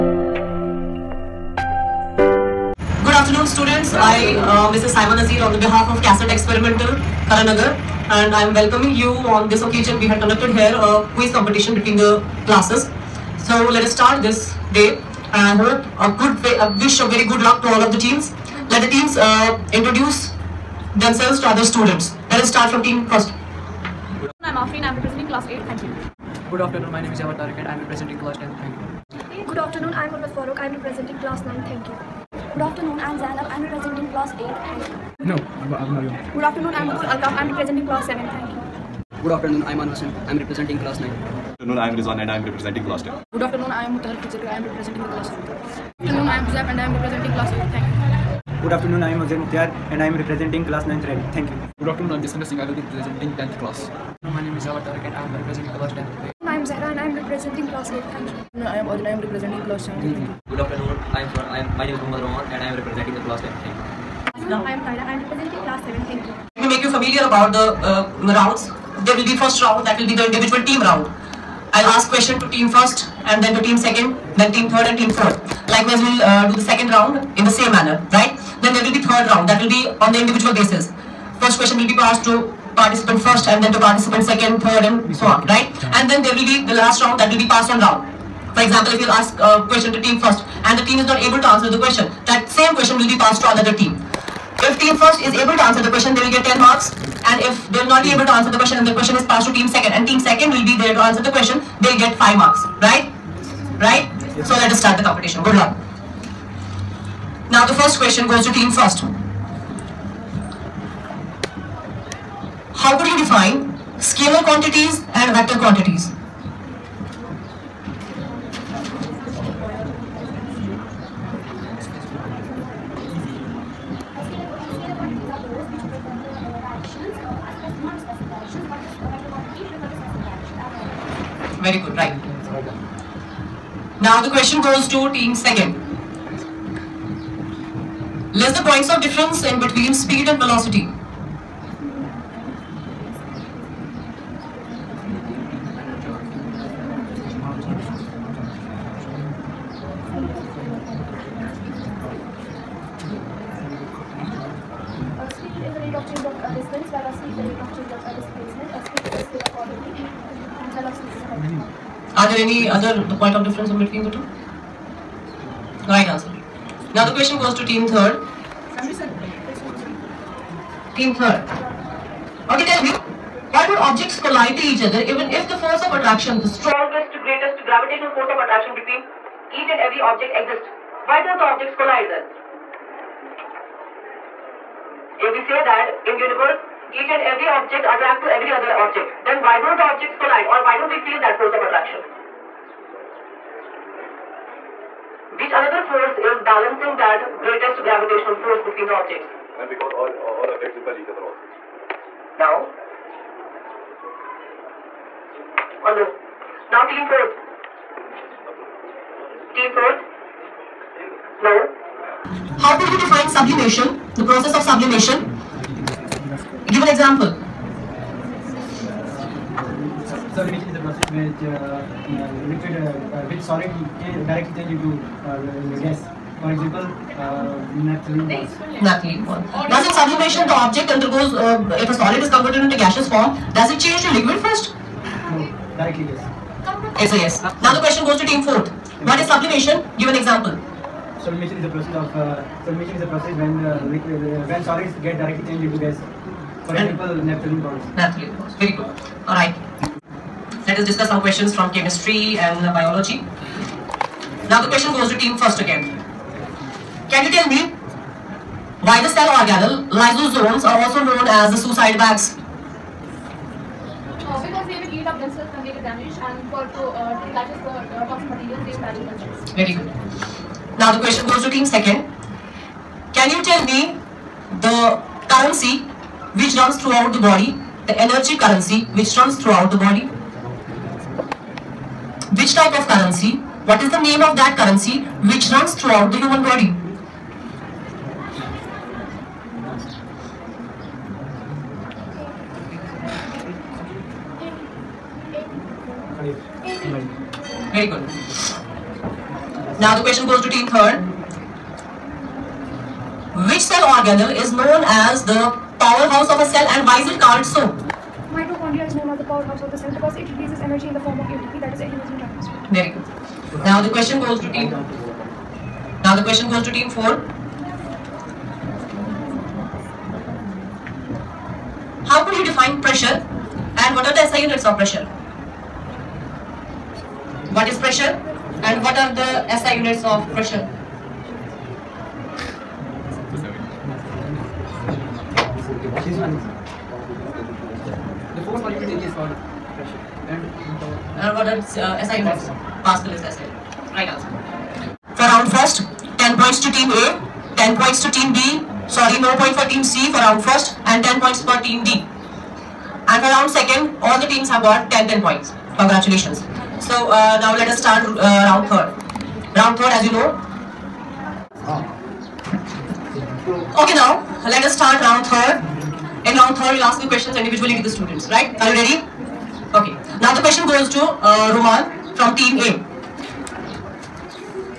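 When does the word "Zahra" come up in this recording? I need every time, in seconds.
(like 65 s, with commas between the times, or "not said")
56 s.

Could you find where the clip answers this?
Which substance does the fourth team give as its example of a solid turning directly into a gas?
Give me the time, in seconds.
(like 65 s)
247 s.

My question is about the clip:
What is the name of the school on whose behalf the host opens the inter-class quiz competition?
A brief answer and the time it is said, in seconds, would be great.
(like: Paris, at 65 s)
CASET Experimental, at 6 s.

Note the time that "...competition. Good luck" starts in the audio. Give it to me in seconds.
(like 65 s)
105 s.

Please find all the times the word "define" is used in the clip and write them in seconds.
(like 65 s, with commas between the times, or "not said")
113 s, 212 s, 322 s.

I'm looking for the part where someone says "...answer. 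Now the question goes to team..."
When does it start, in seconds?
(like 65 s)
166 s.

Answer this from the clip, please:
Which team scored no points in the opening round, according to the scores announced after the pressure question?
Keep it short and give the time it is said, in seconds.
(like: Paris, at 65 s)
Team C, at 349 s.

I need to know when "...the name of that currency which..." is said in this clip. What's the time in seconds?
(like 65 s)
283 s.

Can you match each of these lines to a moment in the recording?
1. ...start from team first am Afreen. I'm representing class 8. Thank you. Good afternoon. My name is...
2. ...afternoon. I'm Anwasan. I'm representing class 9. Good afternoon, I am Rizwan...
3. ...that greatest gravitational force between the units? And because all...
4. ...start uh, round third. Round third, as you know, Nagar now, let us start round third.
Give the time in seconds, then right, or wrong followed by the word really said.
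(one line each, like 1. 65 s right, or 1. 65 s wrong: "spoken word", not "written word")
1. 22 s right
2. 39 s right
3. 196 s wrong: "objects", not "units"
4. 357 s wrong: "Okay", not "Nagar".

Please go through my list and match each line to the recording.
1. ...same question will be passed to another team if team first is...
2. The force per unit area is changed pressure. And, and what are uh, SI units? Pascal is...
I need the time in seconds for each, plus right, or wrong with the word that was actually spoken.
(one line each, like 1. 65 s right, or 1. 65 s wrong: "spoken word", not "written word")
1. 92 s right
2. 338 s wrong: "called", not "changed".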